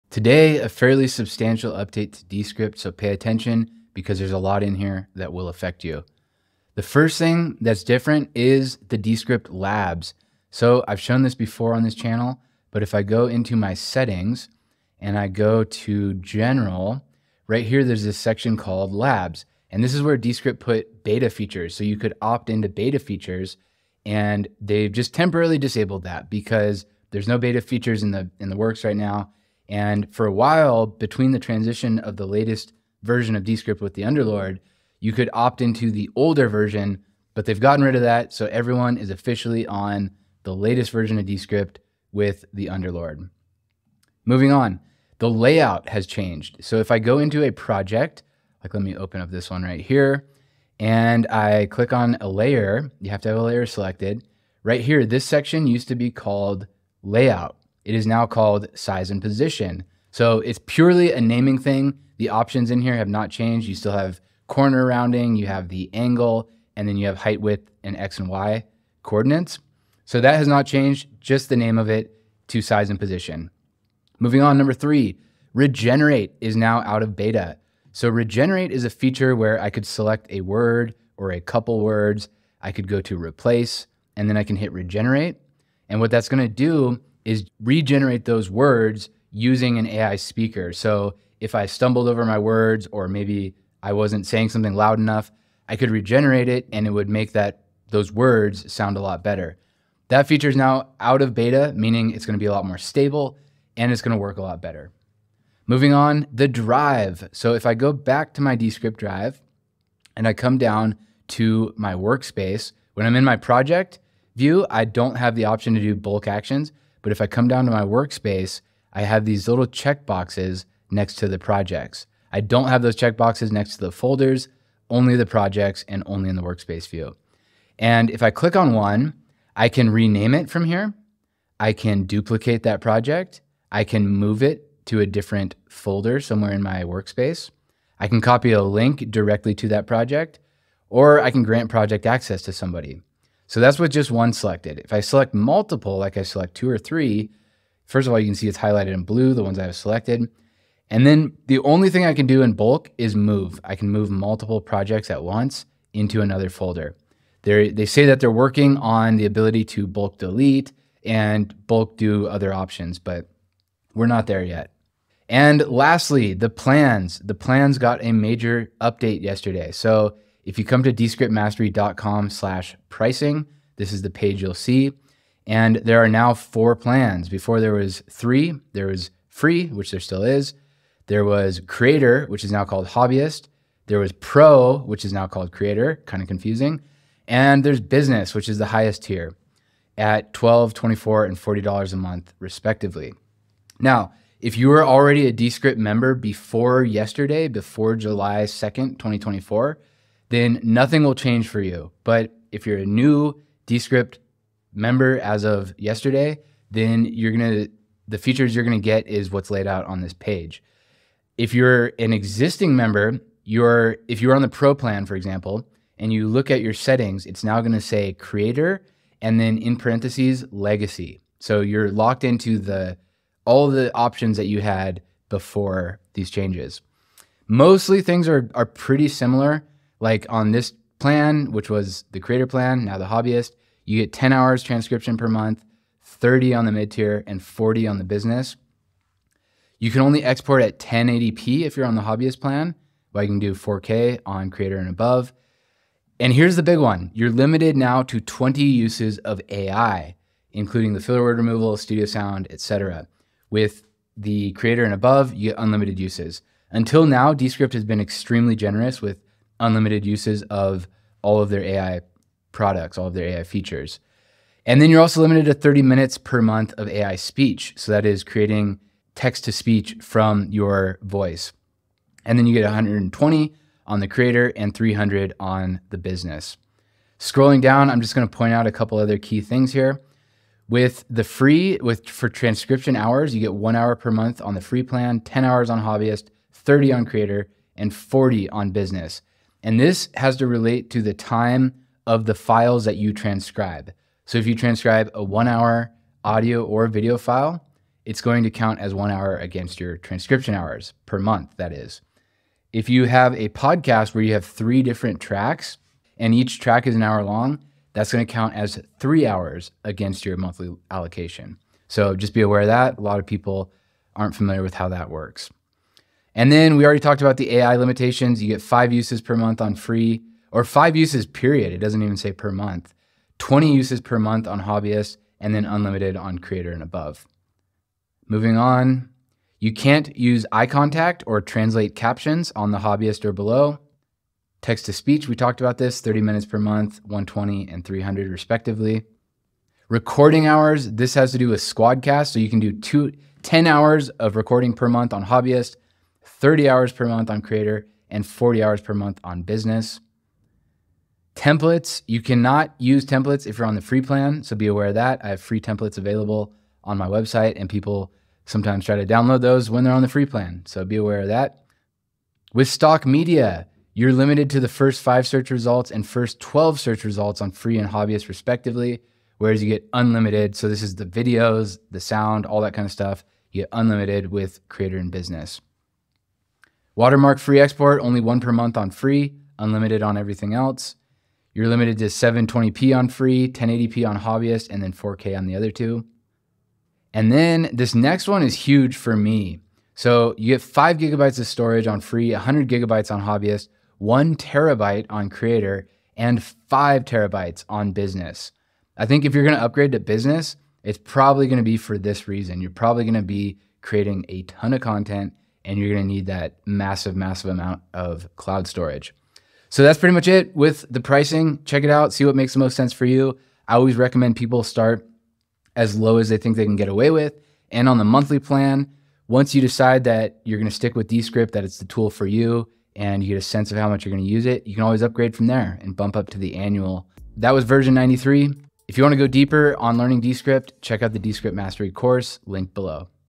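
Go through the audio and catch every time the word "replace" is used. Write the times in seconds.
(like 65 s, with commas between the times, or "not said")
83 s.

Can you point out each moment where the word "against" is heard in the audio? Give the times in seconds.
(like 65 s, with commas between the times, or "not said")
299 s, 309 s.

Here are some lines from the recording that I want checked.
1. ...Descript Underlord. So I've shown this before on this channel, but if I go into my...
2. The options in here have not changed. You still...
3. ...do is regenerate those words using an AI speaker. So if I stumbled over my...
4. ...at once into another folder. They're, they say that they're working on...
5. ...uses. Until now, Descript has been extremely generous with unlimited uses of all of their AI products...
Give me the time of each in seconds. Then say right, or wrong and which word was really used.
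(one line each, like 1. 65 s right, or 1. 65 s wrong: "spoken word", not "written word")
1. 8 s wrong: "Labs", not "Underlord"
2. 62 s right
3. 86 s right
4. 155 s right
5. 255 s right.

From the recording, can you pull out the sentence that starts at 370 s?
So, this is the videos, the sound, all that kind of stuff.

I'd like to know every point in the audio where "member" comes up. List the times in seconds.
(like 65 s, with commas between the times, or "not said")
195 s, 204 s, 212 s.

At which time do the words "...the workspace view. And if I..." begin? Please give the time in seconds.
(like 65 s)
126 s.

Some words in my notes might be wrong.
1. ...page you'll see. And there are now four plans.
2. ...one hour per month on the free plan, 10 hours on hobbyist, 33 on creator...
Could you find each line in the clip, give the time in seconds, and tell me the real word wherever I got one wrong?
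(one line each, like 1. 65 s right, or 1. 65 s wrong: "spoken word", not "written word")
1. 174 s right
2. 283 s wrong: "30", not "33".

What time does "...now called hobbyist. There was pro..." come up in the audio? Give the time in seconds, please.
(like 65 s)
182 s.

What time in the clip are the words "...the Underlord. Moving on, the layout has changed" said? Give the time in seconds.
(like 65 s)
42 s.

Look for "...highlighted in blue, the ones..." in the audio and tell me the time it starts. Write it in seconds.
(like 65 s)
148 s.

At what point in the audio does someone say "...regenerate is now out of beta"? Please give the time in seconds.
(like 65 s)
75 s.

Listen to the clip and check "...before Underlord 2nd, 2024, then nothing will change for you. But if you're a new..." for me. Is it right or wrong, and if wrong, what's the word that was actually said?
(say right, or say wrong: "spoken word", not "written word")
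wrong: "July", not "Underlord".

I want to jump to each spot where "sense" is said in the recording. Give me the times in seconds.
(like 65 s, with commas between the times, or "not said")
412 s, 423 s.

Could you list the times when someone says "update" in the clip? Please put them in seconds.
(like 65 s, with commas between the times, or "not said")
1 s, 168 s.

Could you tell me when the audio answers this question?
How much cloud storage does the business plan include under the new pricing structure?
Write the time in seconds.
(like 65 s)
396 s.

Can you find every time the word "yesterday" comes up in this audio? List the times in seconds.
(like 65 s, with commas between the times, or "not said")
169 s, 196 s, 205 s.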